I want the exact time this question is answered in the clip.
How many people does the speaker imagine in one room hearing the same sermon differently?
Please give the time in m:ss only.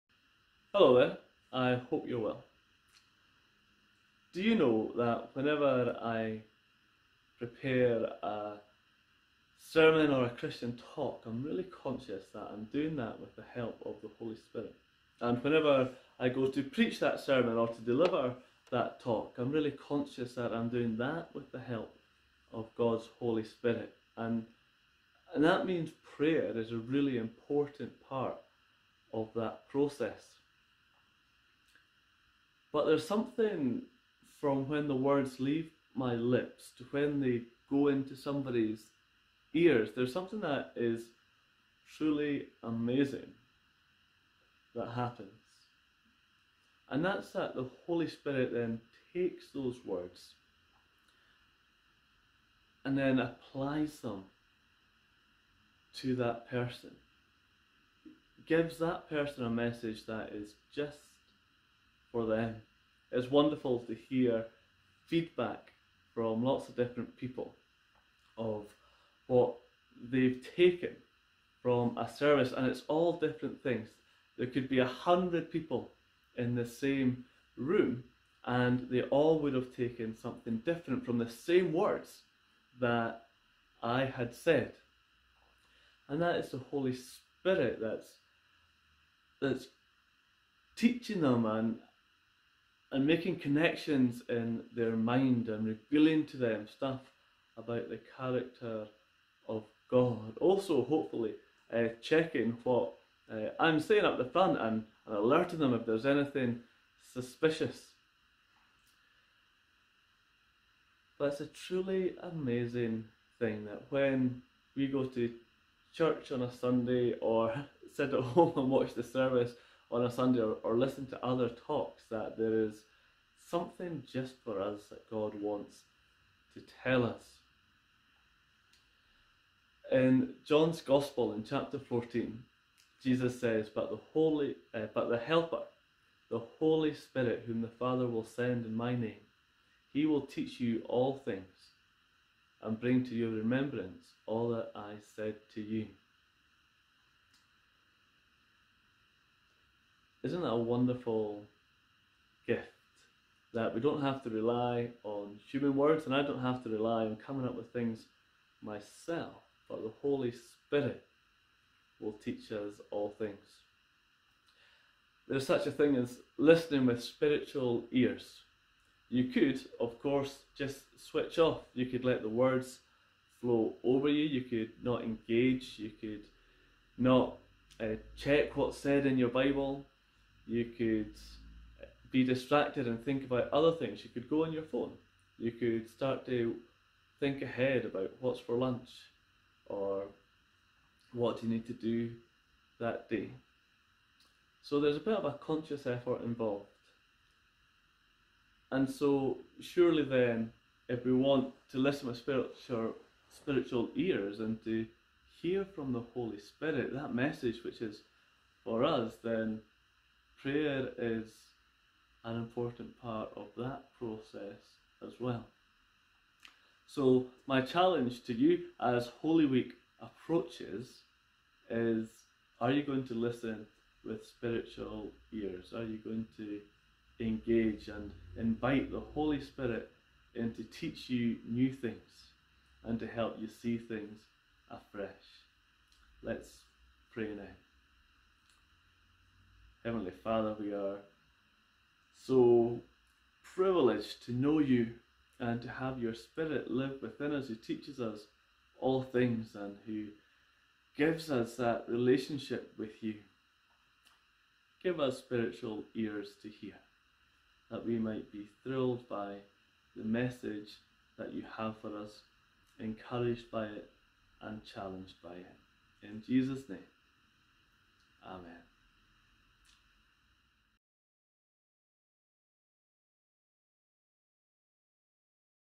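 1:14.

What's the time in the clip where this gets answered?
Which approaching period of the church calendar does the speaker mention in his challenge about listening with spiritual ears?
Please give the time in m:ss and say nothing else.
3:39.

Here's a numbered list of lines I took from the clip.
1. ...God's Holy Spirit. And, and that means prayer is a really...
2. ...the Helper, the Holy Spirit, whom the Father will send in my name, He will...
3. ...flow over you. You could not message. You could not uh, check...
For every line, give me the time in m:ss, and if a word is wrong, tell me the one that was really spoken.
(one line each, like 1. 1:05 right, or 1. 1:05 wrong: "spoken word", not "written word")
1. 0:22 right
2. 2:15 right
3. 2:53 wrong: "engage", not "message".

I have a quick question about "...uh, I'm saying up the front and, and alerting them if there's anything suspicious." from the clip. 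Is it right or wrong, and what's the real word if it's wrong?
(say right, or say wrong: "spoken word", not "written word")
right.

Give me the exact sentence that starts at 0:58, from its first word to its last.
Gives that person a message that is just for them.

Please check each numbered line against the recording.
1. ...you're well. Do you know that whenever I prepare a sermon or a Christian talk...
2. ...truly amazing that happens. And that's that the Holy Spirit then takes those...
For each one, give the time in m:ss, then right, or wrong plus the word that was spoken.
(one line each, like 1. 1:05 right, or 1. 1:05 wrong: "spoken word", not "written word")
1. 0:02 right
2. 0:41 right.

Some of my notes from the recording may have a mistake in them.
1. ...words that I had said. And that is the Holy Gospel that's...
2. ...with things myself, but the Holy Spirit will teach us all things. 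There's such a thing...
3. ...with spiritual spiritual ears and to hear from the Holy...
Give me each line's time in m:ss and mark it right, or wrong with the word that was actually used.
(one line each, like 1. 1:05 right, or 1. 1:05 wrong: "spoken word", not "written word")
1. 1:21 wrong: "Spirit", not "Gospel"
2. 2:37 right
3. 3:22 right.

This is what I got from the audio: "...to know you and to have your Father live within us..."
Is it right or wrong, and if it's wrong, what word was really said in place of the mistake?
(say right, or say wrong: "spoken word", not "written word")
wrong: "Spirit", not "Father".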